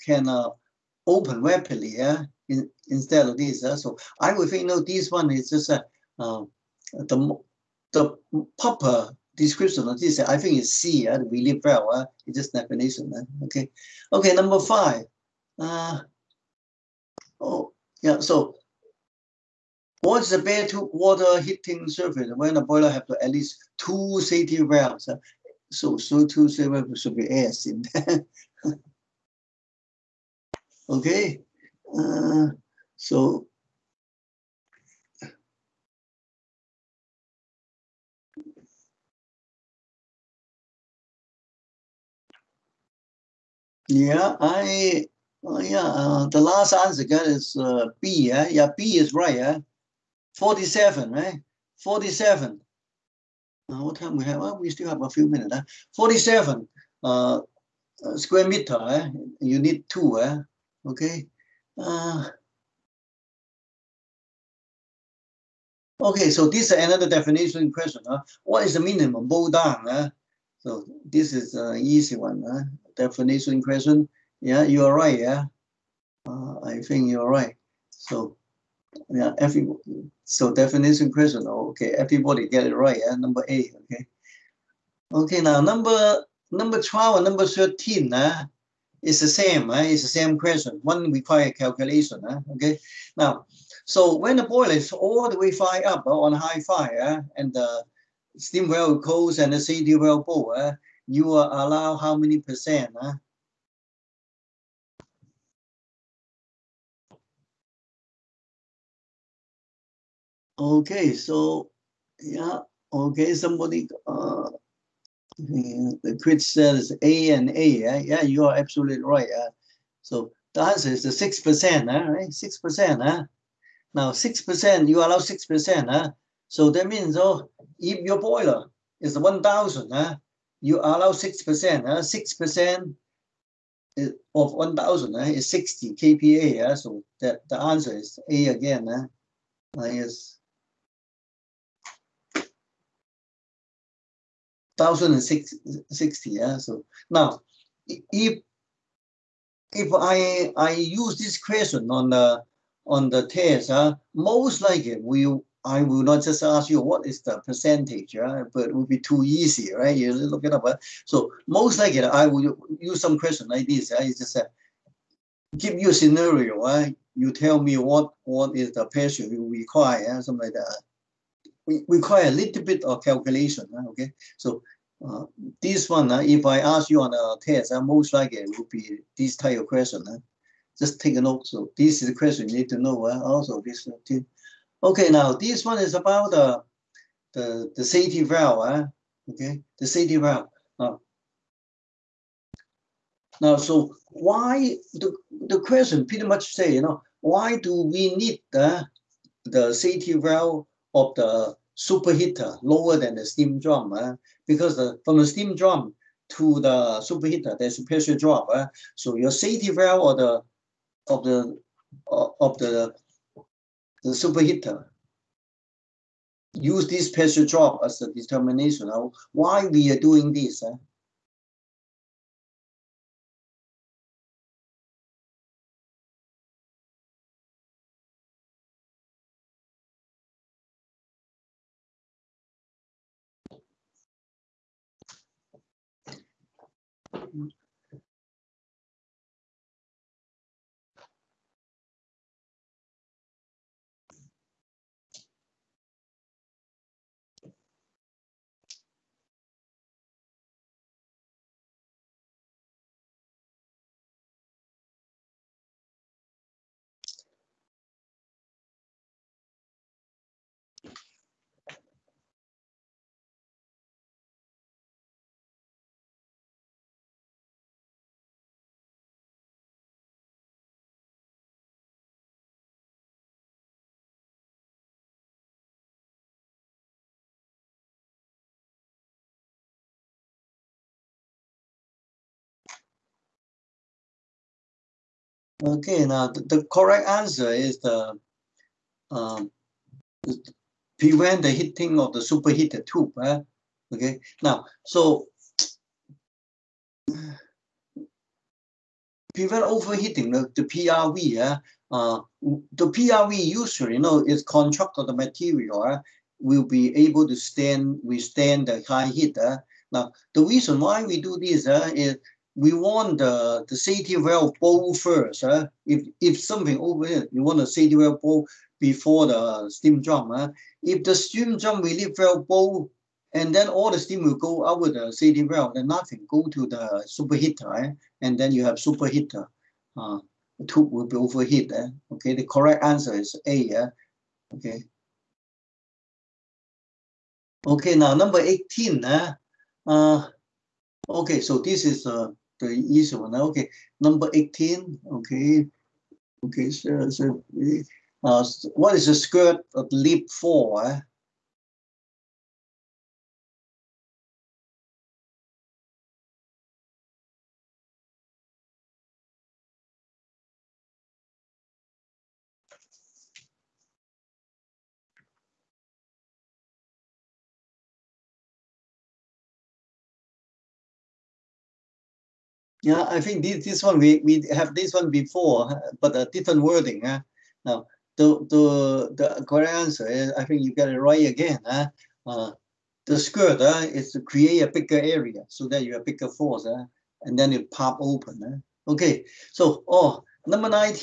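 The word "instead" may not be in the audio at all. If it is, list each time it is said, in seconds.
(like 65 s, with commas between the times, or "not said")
2 s.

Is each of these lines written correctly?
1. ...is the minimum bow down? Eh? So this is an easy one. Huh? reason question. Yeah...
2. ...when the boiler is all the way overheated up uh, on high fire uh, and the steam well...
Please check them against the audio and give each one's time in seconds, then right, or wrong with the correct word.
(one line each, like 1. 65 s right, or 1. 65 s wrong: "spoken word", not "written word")
1. 68 s wrong: "definition", not "reason"
2. 94 s wrong: "fired", not "overheated".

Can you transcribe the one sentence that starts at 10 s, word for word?
I think it's C, uh, live well.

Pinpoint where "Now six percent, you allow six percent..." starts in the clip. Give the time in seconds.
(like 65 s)
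123 s.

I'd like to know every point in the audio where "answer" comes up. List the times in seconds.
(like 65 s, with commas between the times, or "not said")
46 s, 120 s, 137 s, 287 s, 332 s, 379 s.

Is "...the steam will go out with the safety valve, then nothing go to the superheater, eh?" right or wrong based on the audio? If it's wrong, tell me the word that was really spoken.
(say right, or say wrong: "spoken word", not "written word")
right.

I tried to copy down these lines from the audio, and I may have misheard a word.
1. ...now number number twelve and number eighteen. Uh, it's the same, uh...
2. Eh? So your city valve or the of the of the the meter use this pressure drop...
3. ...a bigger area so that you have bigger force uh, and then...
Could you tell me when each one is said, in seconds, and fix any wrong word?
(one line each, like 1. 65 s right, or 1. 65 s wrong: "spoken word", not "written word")
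1. 85 s wrong: "thirteen", not "eighteen"
2. 208 s wrong: "superheater", not "meter"
3. 384 s right.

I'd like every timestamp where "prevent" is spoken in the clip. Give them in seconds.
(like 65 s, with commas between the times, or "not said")
290 s, 299 s.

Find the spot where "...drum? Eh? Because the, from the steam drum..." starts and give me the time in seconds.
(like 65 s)
203 s.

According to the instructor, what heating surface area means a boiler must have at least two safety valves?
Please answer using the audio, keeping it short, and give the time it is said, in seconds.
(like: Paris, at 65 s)
47 square meters, at 55 s.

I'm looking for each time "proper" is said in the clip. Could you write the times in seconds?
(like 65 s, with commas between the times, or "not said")
8 s.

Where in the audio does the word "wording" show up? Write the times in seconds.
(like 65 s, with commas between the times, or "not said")
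376 s.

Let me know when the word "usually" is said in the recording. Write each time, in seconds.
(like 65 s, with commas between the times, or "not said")
303 s.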